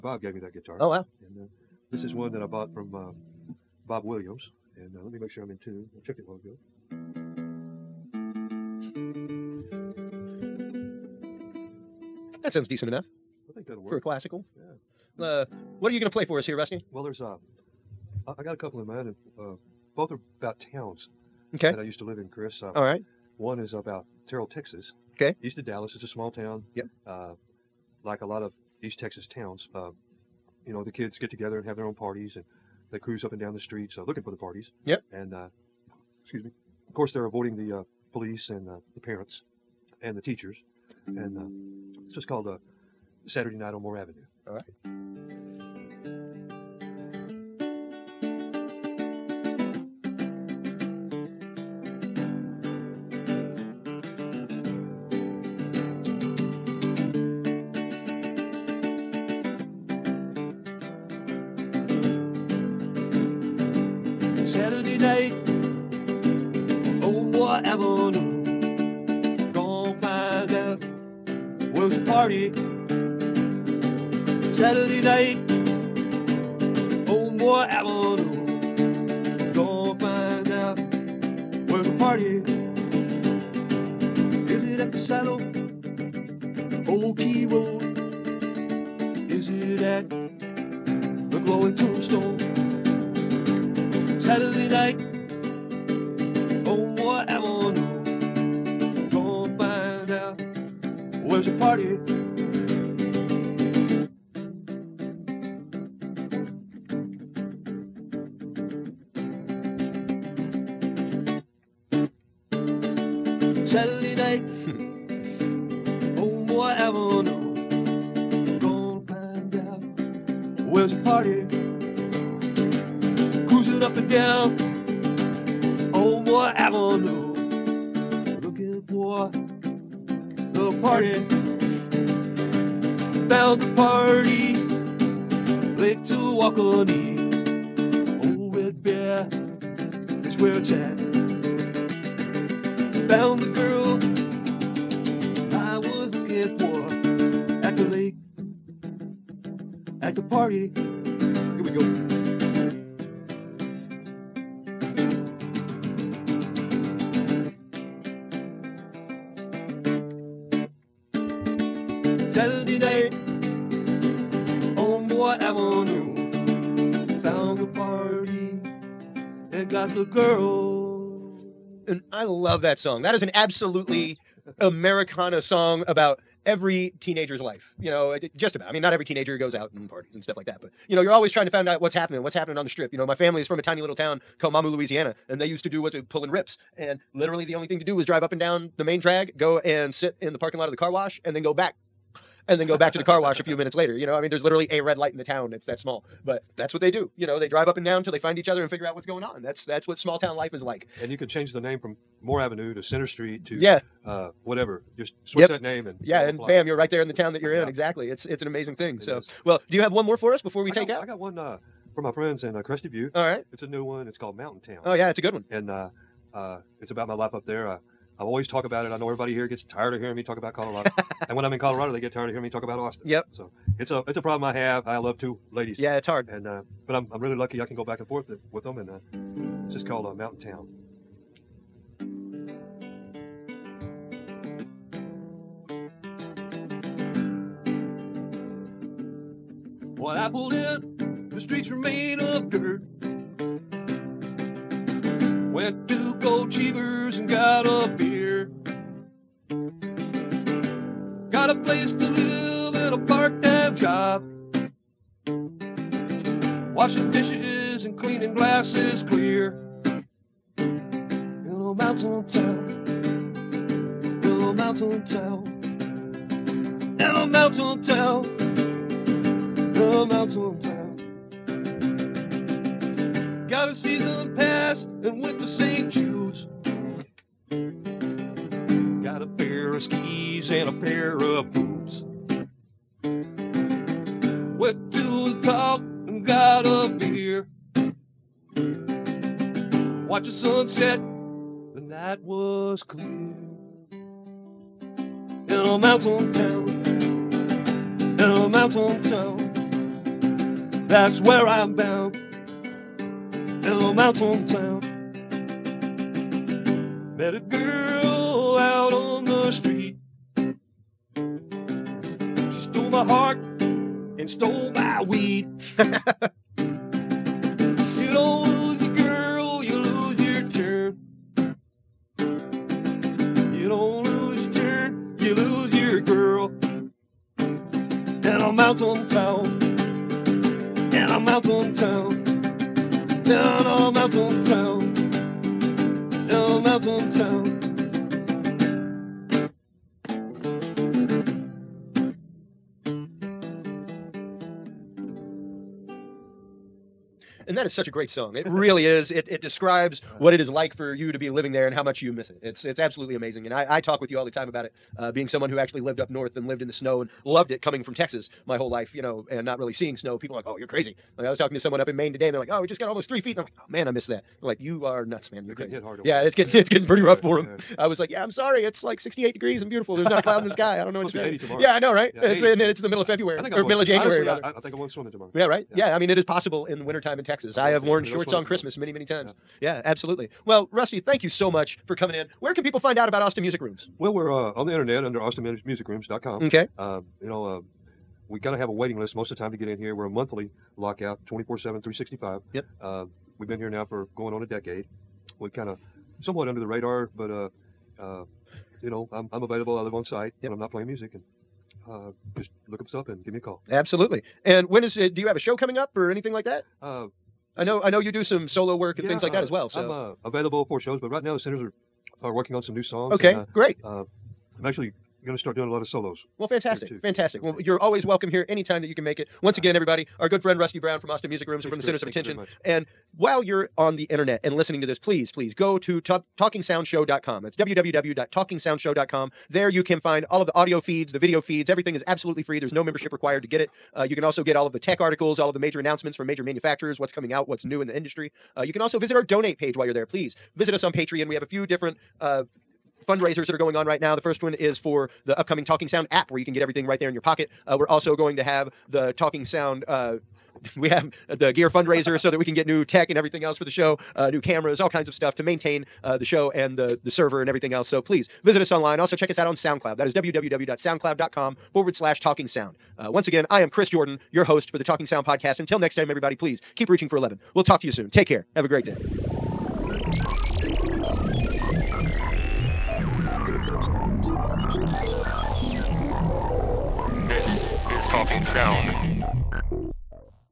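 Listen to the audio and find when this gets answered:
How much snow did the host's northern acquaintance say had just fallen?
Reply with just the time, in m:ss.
6:02.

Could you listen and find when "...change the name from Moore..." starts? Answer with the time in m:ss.
3:21.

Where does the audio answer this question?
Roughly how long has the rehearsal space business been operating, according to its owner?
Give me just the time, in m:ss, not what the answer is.
6:34.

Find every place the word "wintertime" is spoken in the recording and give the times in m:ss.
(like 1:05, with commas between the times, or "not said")
6:16.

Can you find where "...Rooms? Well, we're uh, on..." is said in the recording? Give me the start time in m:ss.
6:23.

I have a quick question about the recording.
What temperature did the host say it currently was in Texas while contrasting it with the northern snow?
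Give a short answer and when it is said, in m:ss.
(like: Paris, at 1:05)
68 degrees, at 6:08.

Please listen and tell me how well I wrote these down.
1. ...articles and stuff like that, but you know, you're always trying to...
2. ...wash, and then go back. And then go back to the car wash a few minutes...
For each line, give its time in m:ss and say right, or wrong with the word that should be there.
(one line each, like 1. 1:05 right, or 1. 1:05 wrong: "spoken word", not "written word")
1. 2:59 wrong: "parties", not "articles"
2. 3:10 right.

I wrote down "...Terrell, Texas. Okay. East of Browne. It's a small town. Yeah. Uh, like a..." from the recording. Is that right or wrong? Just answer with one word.
wrong.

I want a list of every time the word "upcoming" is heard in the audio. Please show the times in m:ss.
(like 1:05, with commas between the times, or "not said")
7:25.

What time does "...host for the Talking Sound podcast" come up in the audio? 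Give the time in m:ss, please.
7:44.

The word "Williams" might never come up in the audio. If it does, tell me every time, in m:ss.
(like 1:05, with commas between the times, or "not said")
0:04.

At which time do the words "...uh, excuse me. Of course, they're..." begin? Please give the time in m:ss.
0:35.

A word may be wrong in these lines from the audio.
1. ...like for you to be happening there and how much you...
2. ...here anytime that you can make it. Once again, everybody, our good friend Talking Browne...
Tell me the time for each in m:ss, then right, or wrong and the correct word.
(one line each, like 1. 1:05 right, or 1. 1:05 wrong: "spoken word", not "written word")
1. 5:50 wrong: "living", not "happening"
2. 6:58 wrong: "Rusty", not "Talking".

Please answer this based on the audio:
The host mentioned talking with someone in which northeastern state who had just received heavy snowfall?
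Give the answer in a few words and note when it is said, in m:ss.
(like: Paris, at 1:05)
Maine, at 6:01.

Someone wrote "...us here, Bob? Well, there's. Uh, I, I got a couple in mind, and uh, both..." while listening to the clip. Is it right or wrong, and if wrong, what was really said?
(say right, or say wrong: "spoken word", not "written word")
wrong: "Rusty", not "Bob".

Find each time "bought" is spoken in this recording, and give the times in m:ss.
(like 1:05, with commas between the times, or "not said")
0:02.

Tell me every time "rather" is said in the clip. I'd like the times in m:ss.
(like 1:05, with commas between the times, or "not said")
6:14.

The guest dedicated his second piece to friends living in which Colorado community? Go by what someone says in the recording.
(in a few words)
Crested Butte.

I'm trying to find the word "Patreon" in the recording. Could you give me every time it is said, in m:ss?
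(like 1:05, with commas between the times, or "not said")
7:20.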